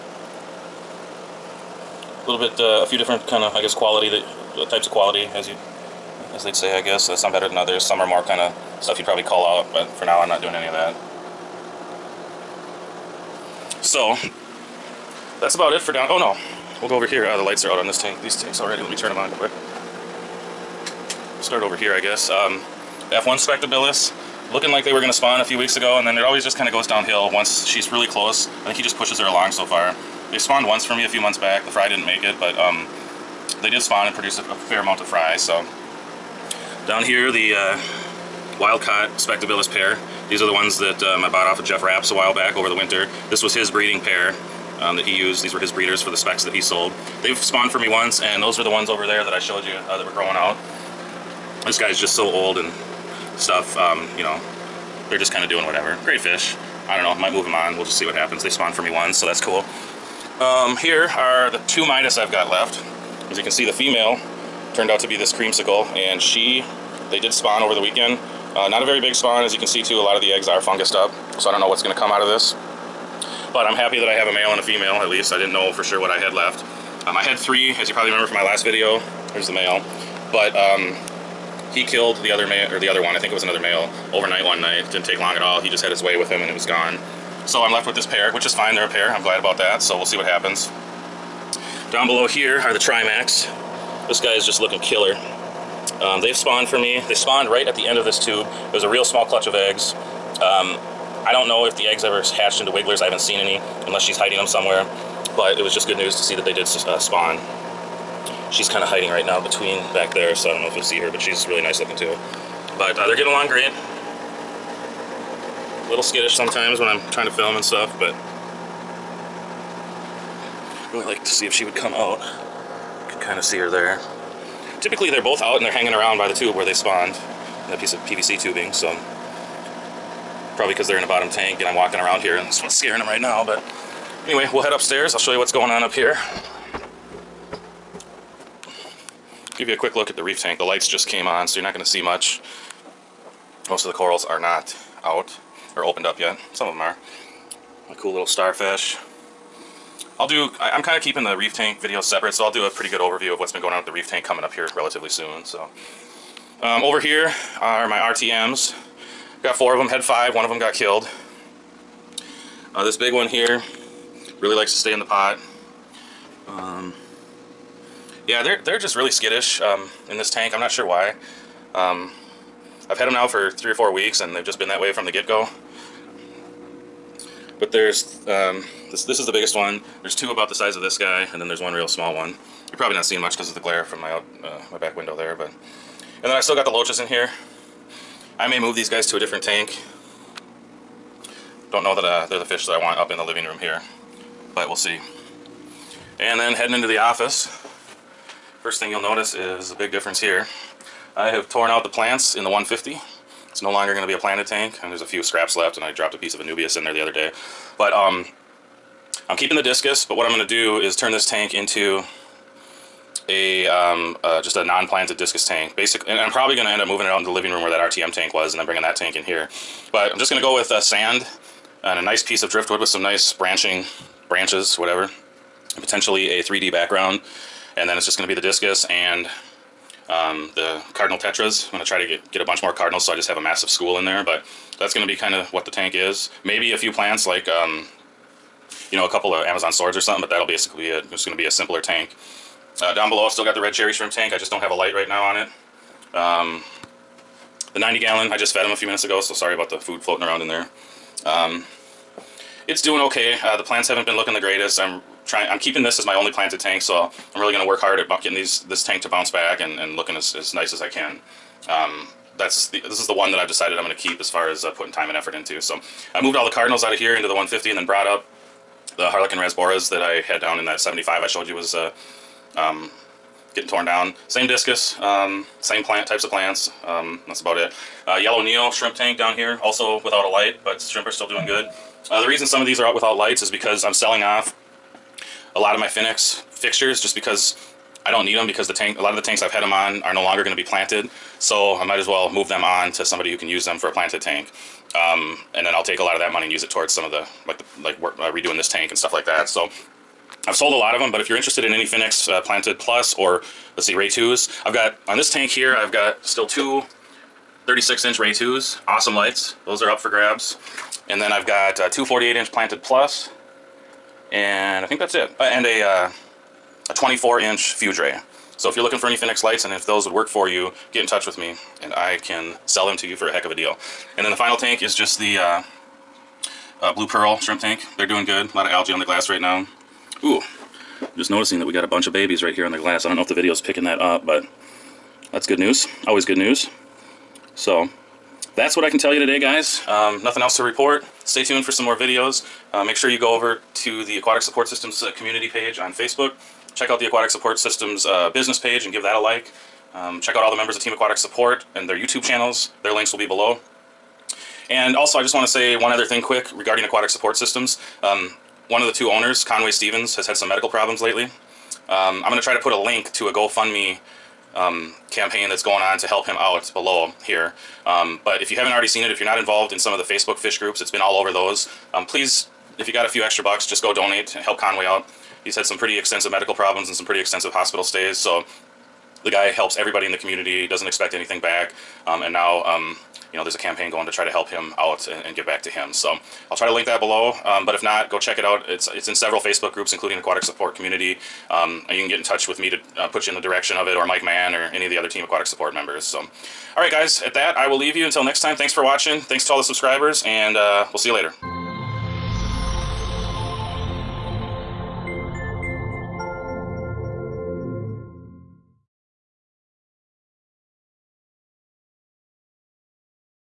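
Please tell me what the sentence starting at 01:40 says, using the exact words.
Um, I don't know if the eggs ever hatched into wigglers.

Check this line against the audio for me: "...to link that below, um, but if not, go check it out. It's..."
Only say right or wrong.
right.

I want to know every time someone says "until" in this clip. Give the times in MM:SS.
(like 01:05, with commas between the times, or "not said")
06:38.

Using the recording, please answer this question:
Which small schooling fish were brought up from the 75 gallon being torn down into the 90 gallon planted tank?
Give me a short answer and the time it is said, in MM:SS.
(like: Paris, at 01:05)
Harlequin Rasboras, at 04:29.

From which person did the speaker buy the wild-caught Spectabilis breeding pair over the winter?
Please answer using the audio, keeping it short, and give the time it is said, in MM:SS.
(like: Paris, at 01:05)
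Jeff Raps, at 00:41.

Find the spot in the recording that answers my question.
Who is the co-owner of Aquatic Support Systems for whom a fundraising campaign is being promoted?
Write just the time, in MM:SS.
05:59.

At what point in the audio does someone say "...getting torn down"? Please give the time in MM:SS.
04:33.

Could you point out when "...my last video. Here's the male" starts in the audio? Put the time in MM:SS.
01:18.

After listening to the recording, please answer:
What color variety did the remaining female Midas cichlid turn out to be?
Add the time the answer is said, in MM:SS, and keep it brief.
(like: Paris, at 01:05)
Creamsicle, at 01:05.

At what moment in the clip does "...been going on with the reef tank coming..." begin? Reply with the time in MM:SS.
02:33.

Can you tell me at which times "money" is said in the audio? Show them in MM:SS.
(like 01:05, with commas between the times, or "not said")
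04:56.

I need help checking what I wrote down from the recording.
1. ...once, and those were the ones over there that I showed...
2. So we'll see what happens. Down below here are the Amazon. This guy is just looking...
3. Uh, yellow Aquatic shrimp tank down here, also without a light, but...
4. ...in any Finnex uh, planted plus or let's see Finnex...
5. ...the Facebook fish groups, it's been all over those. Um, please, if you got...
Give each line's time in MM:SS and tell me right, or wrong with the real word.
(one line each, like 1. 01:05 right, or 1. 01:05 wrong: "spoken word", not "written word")
1. 00:47 right
2. 01:29 wrong: "Trimacs", not "Amazon"
3. 04:38 wrong: "Neo", not "Aquatic"
4. 05:01 wrong: "Ray", not "Finnex"
5. 06:09 right.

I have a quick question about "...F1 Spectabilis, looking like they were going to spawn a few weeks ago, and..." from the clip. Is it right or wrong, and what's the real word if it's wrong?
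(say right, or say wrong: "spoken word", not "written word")
right.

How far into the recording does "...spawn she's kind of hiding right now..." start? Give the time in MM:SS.
01:46.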